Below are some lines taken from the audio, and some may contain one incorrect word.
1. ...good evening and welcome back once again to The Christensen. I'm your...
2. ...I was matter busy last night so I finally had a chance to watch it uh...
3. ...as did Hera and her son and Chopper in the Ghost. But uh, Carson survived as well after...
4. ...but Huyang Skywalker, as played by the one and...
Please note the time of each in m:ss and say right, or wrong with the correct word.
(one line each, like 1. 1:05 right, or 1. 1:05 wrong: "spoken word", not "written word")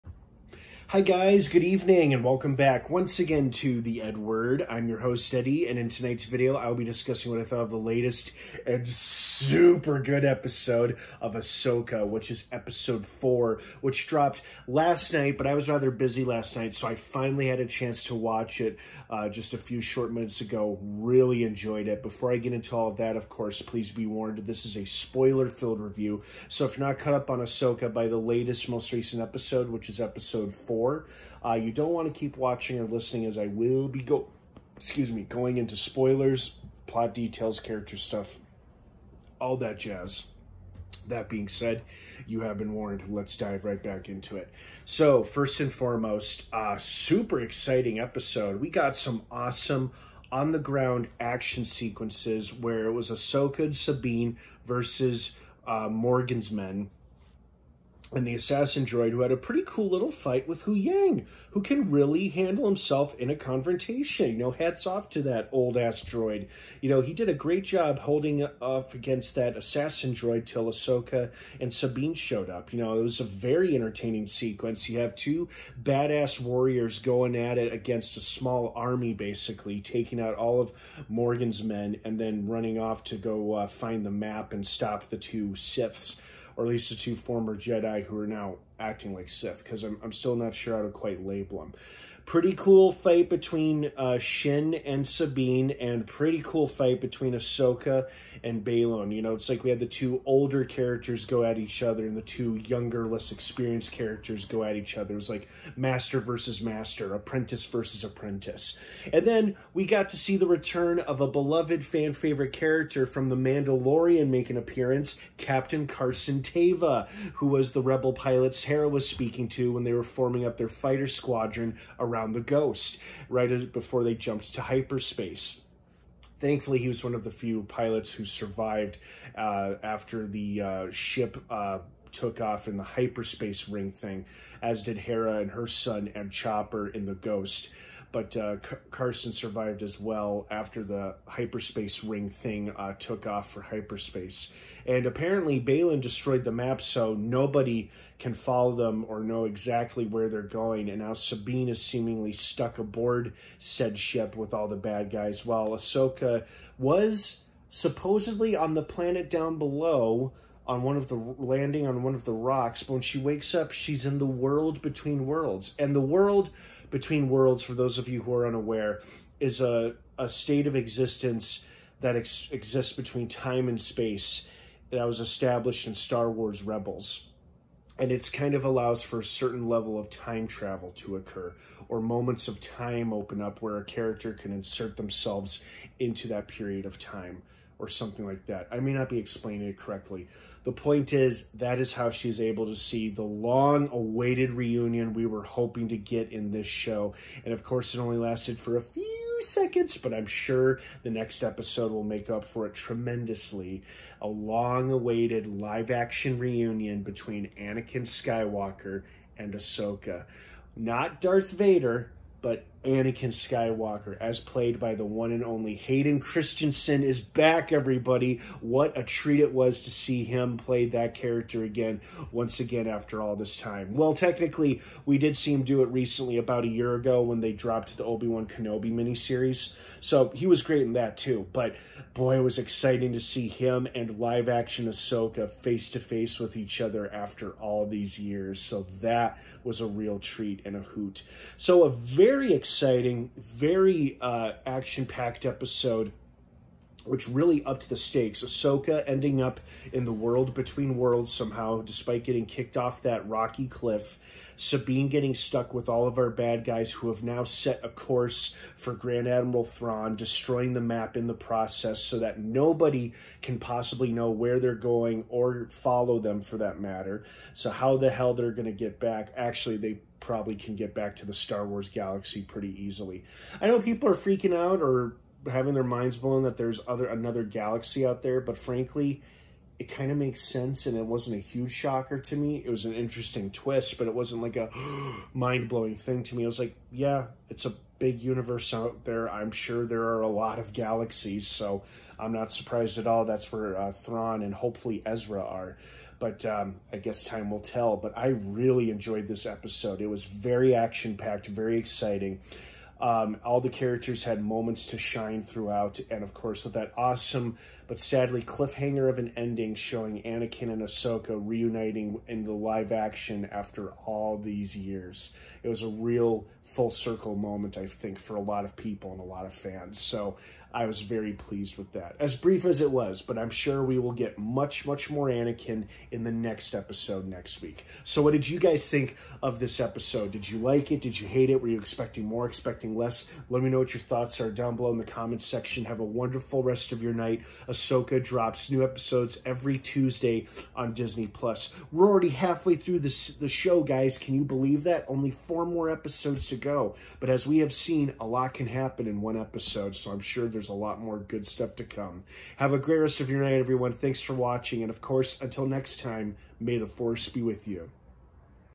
1. 0:01 wrong: "EdWord", not "Christensen"
2. 0:15 wrong: "rather", not "matter"
3. 2:14 right
4. 3:32 wrong: "Anakin", not "Huyang".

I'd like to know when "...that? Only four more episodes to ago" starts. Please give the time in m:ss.
5:44.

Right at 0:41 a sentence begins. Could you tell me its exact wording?
That being said, you have been warned.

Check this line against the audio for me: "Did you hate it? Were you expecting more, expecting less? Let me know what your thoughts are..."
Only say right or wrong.
right.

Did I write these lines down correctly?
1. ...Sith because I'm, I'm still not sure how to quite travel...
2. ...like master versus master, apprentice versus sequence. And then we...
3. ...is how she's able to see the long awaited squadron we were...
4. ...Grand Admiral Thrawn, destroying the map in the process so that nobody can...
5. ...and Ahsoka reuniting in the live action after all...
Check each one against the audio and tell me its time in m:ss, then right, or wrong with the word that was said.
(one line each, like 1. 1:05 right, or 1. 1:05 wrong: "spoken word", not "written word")
1. 1:29 wrong: "label", not "travel"
2. 1:45 wrong: "apprentice", not "sequence"
3. 3:11 wrong: "reunion", not "squadron"
4. 4:18 right
5. 5:10 right.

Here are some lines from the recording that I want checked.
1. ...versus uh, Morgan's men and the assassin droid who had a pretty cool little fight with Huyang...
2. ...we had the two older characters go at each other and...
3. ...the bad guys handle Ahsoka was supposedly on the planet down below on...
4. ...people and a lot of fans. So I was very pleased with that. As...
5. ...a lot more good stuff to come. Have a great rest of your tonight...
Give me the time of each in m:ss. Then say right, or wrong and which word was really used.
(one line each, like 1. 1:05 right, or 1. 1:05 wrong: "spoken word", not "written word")
1. 0:54 right
2. 1:39 right
3. 2:34 wrong: "while", not "handle"
4. 5:18 right
5. 5:50 wrong: "night", not "tonight".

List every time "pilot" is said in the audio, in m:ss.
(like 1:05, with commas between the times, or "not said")
1:58, 2:07.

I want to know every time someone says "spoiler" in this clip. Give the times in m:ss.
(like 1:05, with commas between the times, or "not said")
0:24, 0:35.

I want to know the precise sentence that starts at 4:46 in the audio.
I was like, yeah, it's a big universe out there.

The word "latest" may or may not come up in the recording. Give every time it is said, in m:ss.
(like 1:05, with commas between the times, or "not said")
0:07, 0:28.